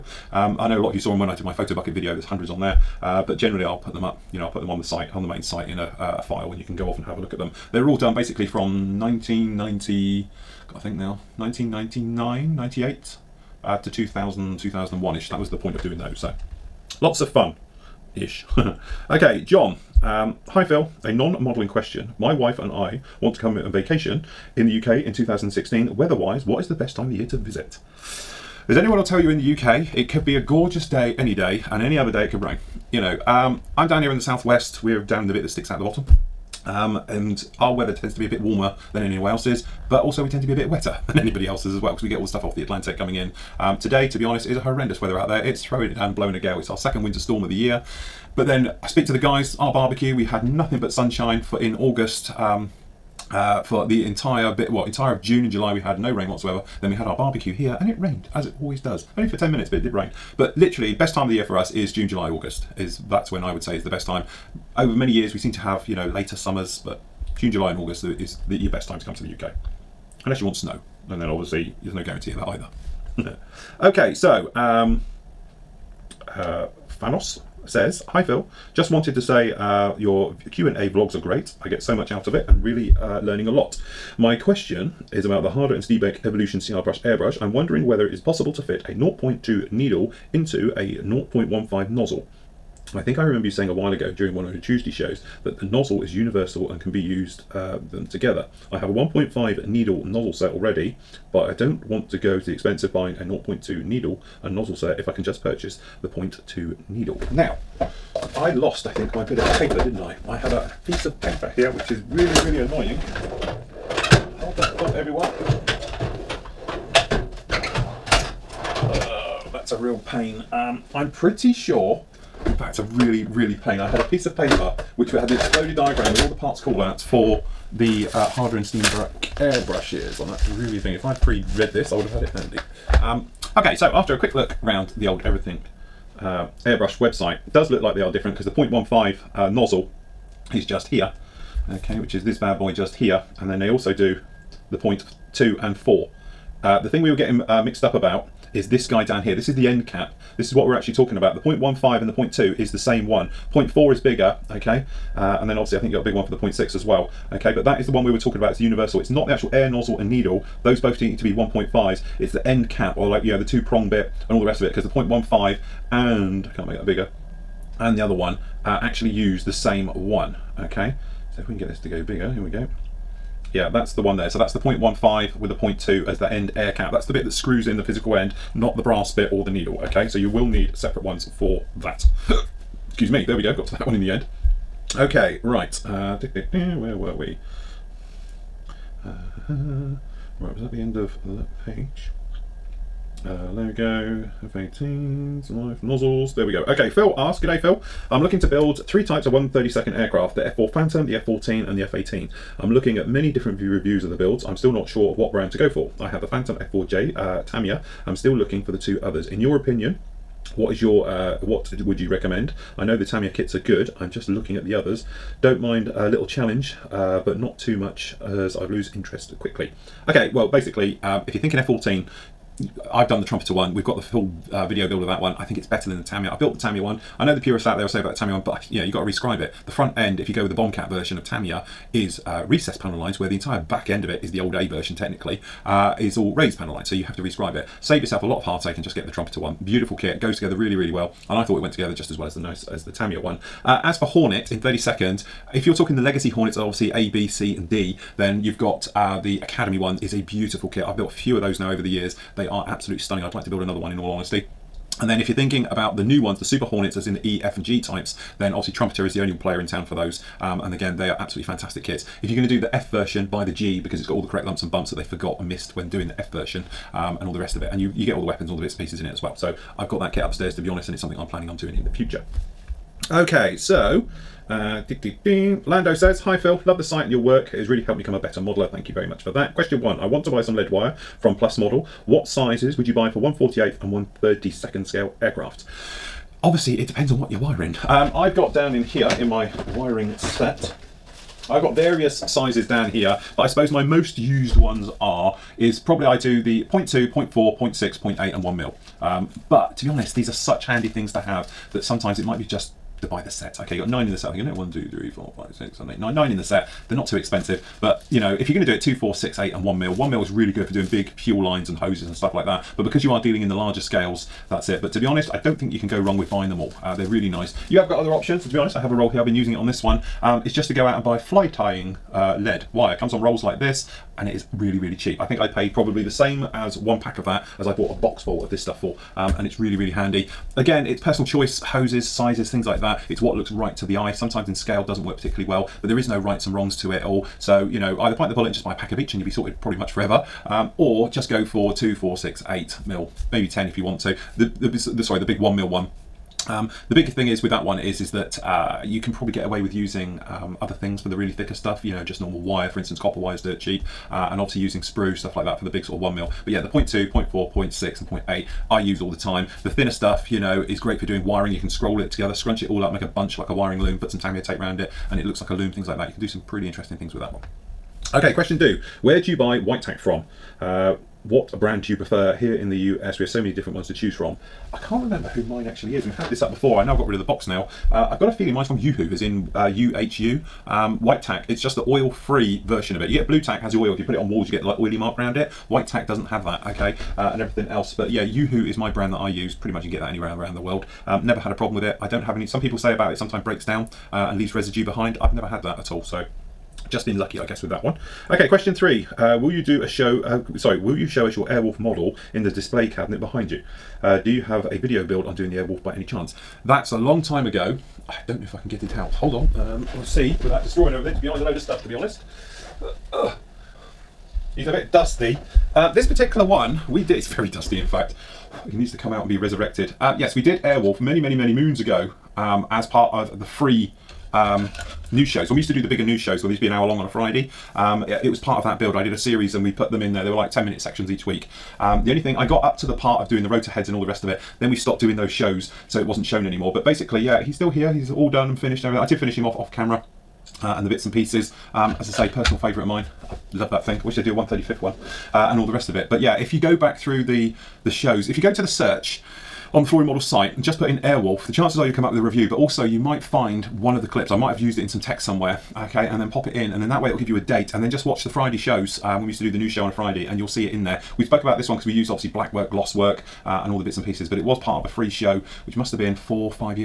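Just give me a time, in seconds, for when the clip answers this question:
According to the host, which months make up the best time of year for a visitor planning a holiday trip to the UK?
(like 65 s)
61 s.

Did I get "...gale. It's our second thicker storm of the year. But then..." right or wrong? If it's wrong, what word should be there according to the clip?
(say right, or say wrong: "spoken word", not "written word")
wrong: "winter", not "thicker".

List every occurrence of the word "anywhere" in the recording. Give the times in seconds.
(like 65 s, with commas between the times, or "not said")
39 s, 390 s.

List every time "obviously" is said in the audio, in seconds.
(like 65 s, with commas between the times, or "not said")
71 s, 155 s, 246 s, 258 s, 286 s, 354 s, 462 s.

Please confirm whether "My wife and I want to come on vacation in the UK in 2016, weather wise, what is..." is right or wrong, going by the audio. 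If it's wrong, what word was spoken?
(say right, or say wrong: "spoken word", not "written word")
right.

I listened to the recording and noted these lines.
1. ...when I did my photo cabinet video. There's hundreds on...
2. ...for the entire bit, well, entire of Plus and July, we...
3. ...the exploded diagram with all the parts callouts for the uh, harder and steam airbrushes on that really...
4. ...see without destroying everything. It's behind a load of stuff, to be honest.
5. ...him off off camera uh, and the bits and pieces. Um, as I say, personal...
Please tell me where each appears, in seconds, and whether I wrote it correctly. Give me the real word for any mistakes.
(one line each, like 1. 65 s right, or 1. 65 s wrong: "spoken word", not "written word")
1. 1 s wrong: "bucket", not "cabinet"
2. 53 s wrong: "June", not "Plus"
3. 125 s right
4. 410 s right
5. 439 s right.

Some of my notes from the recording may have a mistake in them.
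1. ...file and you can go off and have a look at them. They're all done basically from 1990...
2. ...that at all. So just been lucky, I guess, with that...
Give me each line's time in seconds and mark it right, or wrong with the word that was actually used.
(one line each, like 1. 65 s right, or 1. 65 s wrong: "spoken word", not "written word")
1. 6 s right
2. 395 s right.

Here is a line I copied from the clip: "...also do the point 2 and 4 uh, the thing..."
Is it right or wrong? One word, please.
right.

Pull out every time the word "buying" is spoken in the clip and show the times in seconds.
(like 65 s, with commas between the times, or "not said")
102 s, 316 s.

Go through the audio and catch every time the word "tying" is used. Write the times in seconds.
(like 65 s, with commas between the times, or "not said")
321 s.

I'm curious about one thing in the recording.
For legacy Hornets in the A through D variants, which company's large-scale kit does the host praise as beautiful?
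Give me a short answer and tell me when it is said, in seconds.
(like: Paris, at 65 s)
Academy, at 249 s.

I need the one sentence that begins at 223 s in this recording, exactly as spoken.
We've got the full uh, video build of that one.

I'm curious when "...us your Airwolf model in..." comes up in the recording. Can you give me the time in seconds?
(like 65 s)
401 s.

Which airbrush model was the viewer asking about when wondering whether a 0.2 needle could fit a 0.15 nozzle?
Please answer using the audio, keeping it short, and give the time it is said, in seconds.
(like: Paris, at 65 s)
Evolution CR, at 86 s.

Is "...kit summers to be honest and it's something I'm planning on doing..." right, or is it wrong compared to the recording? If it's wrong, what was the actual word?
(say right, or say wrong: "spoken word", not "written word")
wrong: "upstairs", not "summers".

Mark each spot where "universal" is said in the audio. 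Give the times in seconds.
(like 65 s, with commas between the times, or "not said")
96 s, 158 s.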